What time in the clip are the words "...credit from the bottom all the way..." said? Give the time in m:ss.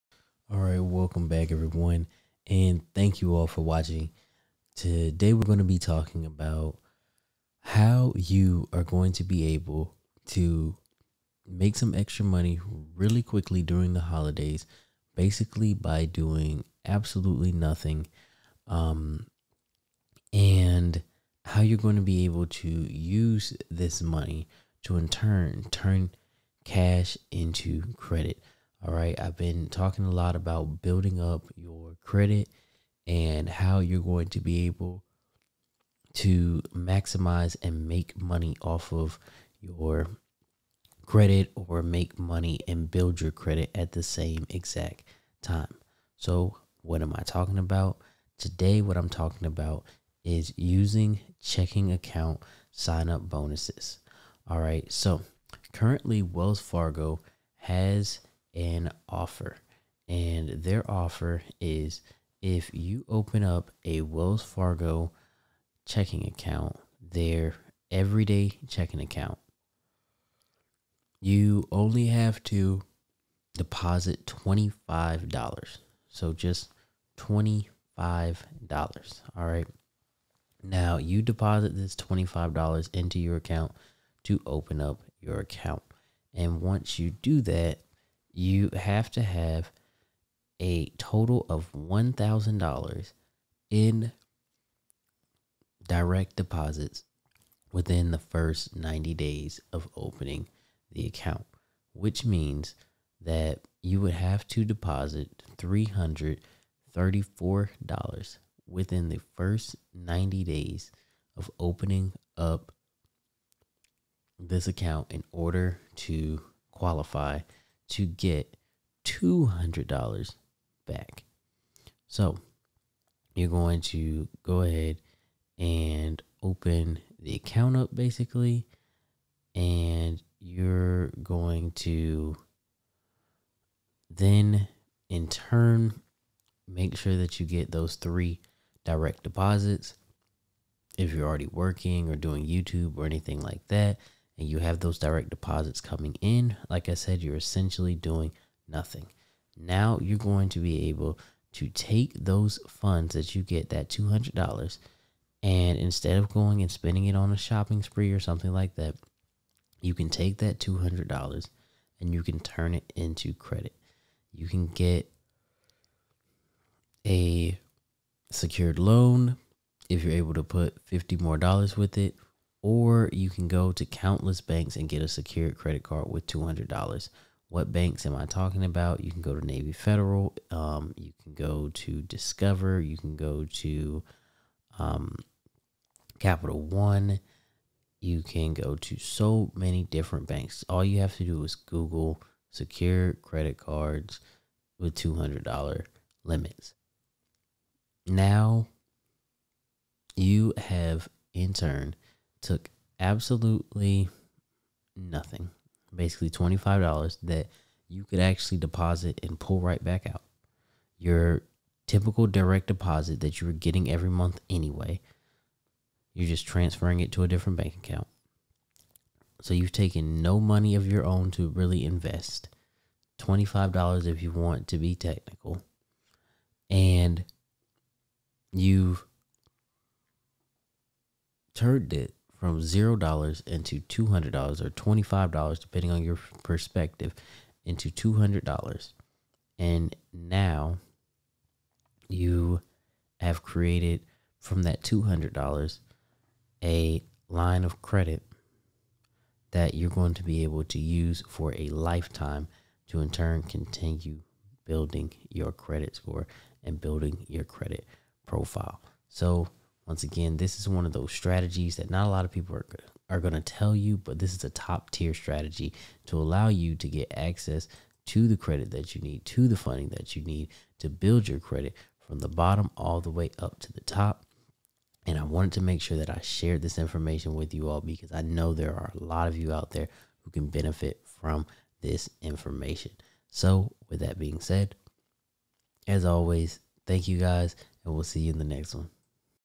4:31.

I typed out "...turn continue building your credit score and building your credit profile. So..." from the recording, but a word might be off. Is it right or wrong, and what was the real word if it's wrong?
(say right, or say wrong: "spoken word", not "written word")
right.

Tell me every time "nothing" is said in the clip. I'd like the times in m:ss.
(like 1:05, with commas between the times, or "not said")
0:17, 2:28, 3:24.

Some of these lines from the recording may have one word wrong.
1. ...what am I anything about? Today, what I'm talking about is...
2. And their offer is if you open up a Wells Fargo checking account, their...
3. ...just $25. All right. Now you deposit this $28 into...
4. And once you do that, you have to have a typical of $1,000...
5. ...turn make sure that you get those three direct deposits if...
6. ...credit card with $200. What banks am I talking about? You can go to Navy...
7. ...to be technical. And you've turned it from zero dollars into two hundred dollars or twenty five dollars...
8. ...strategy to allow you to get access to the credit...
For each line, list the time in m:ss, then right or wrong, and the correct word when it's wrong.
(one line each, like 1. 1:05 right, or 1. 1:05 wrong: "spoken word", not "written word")
1. 0:46 wrong: "talking", not "anything"
2. 1:00 right
3. 1:16 wrong: "25", not "28"
4. 1:26 wrong: "total", not "typical"
5. 2:15 right
6. 2:55 right
7. 3:44 right
8. 4:25 right.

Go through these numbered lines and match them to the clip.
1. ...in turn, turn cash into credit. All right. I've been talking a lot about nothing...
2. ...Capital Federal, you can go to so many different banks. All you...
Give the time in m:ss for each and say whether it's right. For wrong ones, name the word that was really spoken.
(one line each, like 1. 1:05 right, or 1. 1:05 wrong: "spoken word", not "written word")
1. 0:24 wrong: "building", not "nothing"
2. 3:06 wrong: "One", not "Federal".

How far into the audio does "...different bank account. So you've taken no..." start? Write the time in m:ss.
3:37.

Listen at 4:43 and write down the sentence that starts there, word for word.
So, with that being said, as always, thank you guys, and we'll see you in the next one.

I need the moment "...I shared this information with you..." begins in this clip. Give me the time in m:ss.
4:36.